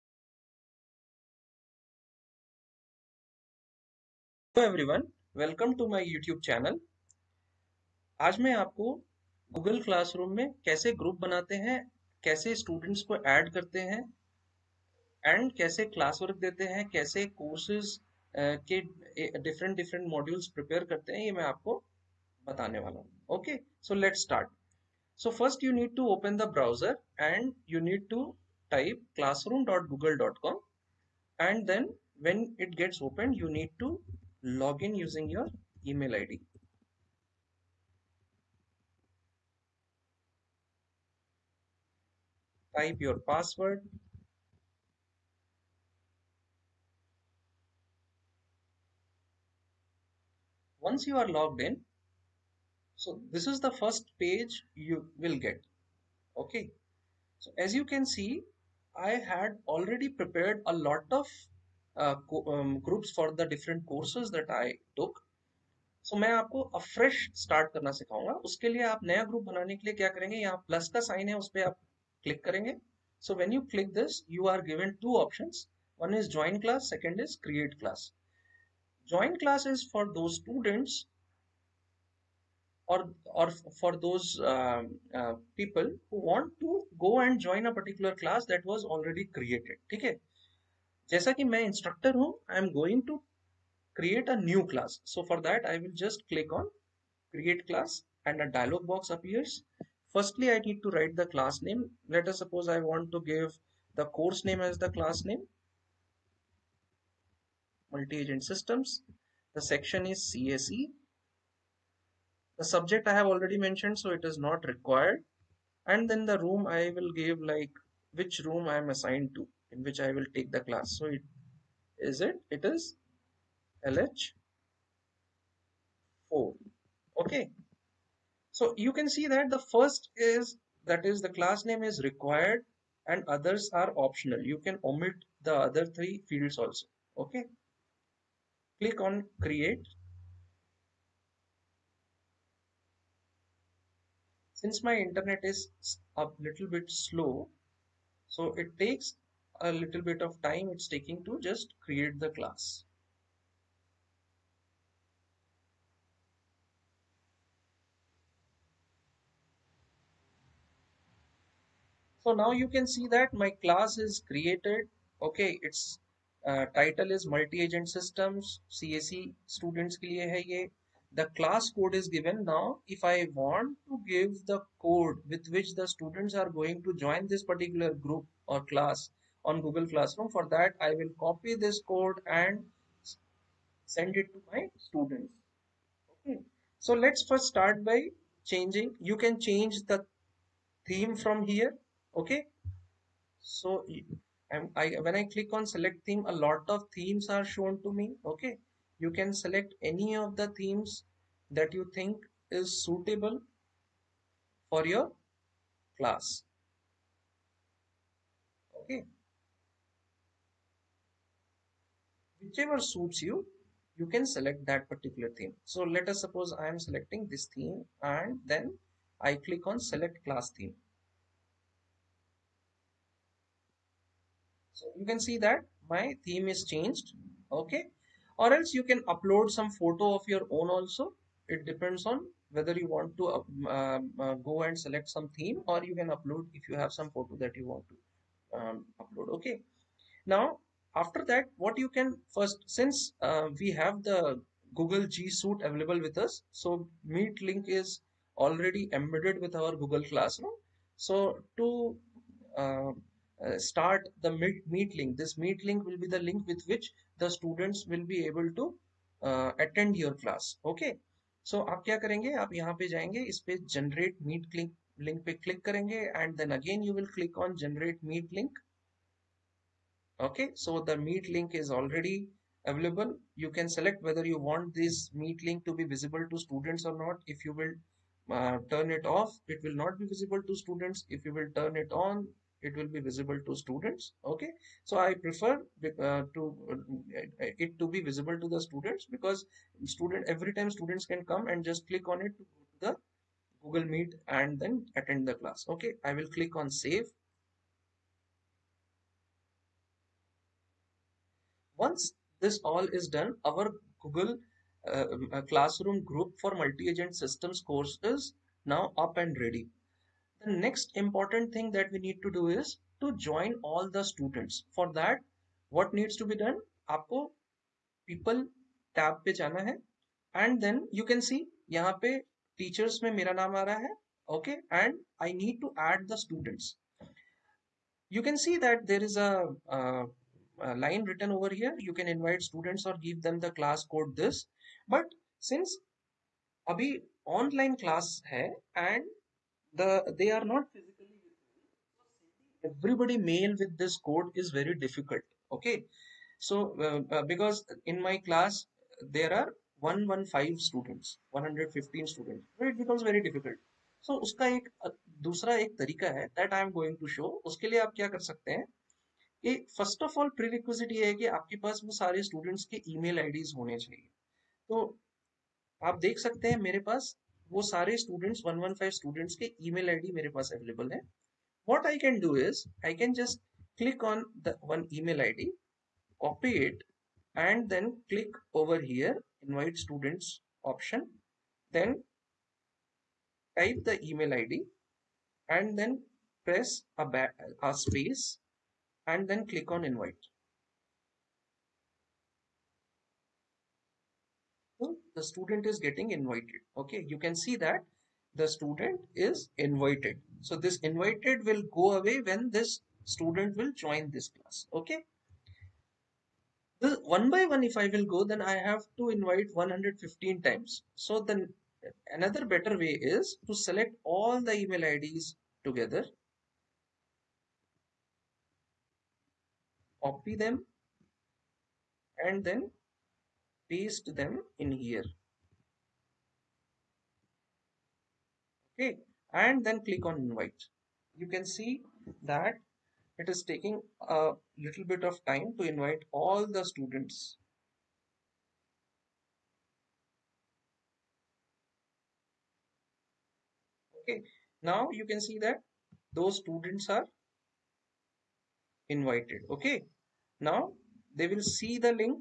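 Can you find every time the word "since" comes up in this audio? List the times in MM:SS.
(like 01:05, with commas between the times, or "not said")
02:24, 04:02, 05:35.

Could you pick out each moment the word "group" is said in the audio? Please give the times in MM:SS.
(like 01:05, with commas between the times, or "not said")
01:02, 02:57, 05:06.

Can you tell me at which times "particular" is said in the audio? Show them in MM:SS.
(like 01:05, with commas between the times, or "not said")
01:27, 02:57, 03:34.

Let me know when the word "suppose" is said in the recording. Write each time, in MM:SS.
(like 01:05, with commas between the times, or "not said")
01:42, 03:36.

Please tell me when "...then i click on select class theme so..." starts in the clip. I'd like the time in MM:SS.
03:38.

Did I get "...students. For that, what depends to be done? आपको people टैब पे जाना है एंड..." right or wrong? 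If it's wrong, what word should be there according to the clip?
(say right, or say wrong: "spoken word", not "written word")
wrong: "needs", not "depends".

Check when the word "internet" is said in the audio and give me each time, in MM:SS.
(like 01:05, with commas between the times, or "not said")
02:24.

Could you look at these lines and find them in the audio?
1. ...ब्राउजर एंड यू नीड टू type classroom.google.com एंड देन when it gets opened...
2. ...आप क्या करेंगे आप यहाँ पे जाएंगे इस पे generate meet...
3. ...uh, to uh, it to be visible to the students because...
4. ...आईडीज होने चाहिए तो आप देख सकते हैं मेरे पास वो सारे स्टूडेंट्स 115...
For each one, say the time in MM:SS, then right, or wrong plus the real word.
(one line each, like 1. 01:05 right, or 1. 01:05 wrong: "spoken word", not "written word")
1. 00:26 right
2. 04:21 right
3. 04:46 right
4. 06:03 right.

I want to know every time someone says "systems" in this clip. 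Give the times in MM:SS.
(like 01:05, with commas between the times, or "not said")
01:48, 02:47, 05:07.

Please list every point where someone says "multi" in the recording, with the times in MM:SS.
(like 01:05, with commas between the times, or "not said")
01:47, 02:47, 05:06.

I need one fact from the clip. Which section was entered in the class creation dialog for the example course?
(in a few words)
CSE.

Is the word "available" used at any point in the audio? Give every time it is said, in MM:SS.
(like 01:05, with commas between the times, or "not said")
04:05, 04:32.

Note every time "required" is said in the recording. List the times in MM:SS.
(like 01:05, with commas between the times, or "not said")
01:54, 02:12.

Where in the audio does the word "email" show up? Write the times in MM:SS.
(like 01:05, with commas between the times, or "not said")
00:35, 06:54.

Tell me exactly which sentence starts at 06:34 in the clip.
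So the student is getting invited.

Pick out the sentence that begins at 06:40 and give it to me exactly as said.
So this invited will go away when this student will join this class.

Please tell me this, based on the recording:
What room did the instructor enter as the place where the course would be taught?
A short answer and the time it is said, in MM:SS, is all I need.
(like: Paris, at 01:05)
LH4, at 02:03.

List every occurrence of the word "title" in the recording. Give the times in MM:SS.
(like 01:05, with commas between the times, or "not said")
02:46.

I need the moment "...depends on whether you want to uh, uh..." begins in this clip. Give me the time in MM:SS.
03:51.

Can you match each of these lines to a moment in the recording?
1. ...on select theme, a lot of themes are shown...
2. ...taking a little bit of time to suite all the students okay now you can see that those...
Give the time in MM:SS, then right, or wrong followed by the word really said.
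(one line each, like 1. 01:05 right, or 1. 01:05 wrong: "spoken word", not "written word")
1. 03:15 right
2. 07:13 wrong: "invite", not "suite".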